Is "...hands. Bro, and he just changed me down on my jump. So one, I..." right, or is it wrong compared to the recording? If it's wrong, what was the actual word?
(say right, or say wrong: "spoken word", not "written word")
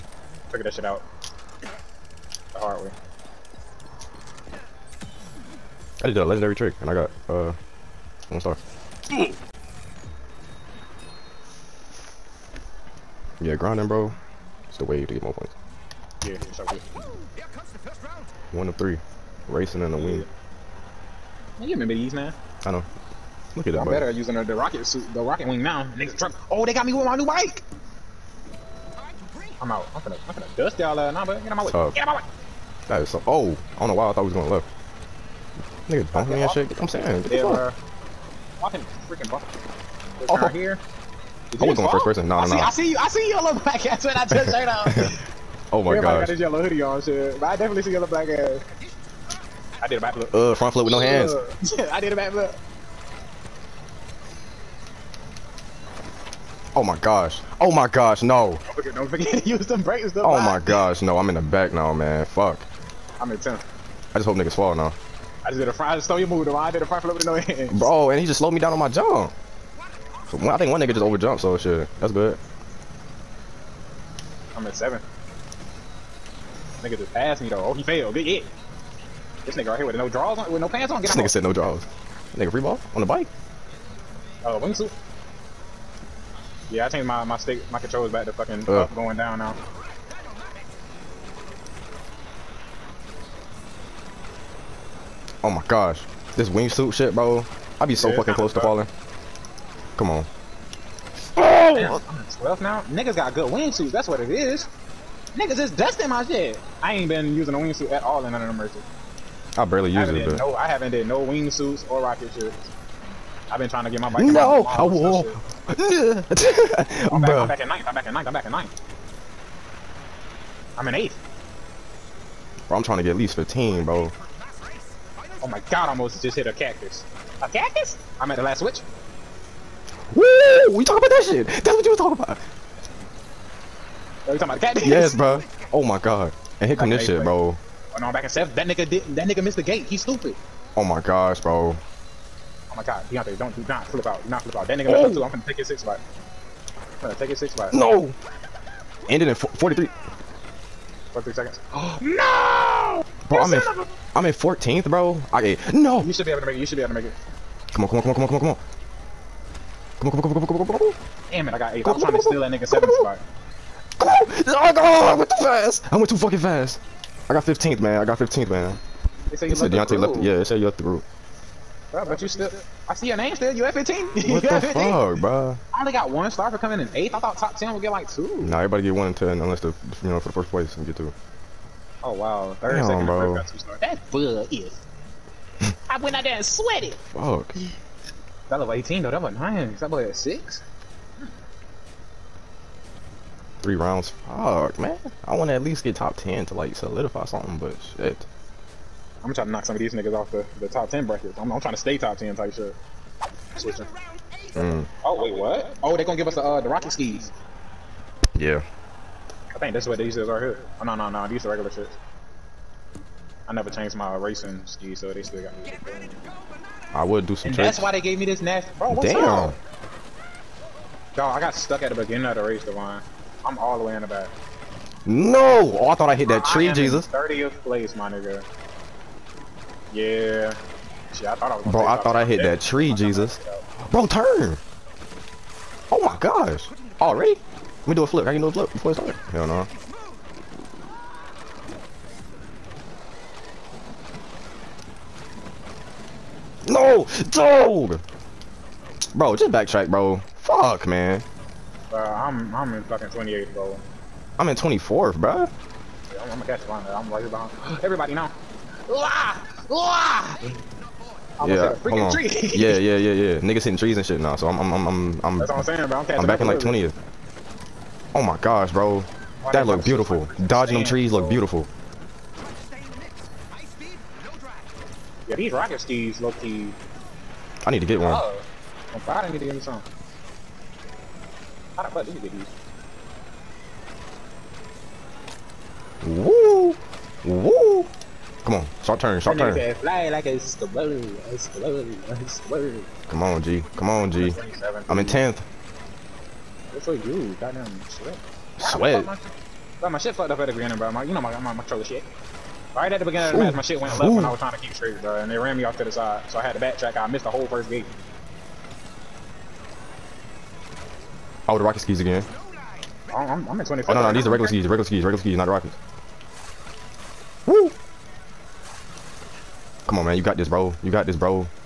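wrong: "slowed", not "changed".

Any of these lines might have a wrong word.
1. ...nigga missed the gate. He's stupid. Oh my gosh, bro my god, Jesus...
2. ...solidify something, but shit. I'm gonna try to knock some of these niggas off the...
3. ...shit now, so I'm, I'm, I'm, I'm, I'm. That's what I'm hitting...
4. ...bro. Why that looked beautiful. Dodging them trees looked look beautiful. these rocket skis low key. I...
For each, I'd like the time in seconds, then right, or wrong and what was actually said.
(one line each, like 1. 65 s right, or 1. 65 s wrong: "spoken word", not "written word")
1. 139 s wrong: "Deontay", not "Jesus"
2. 196 s right
3. 264 s wrong: "saying", not "hitting"
4. 268 s right.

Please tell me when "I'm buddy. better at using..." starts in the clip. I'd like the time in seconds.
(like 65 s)
23 s.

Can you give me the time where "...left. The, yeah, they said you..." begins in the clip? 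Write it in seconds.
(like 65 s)
169 s.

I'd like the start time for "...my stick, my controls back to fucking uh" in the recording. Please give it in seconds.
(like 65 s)
87 s.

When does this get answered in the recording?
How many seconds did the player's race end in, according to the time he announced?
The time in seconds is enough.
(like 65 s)
151 s.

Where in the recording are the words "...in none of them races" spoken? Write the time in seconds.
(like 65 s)
108 s.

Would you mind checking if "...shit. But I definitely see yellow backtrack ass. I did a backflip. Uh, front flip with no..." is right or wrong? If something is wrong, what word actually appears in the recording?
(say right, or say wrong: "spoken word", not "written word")
wrong: "black", not "backtrack".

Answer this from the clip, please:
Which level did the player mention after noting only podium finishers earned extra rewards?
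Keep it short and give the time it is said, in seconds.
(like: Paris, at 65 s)
18, at 188 s.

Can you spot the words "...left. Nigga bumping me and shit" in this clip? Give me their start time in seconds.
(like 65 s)
34 s.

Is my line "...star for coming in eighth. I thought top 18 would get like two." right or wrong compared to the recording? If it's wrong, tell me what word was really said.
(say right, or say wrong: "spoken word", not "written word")
wrong: "10", not "18".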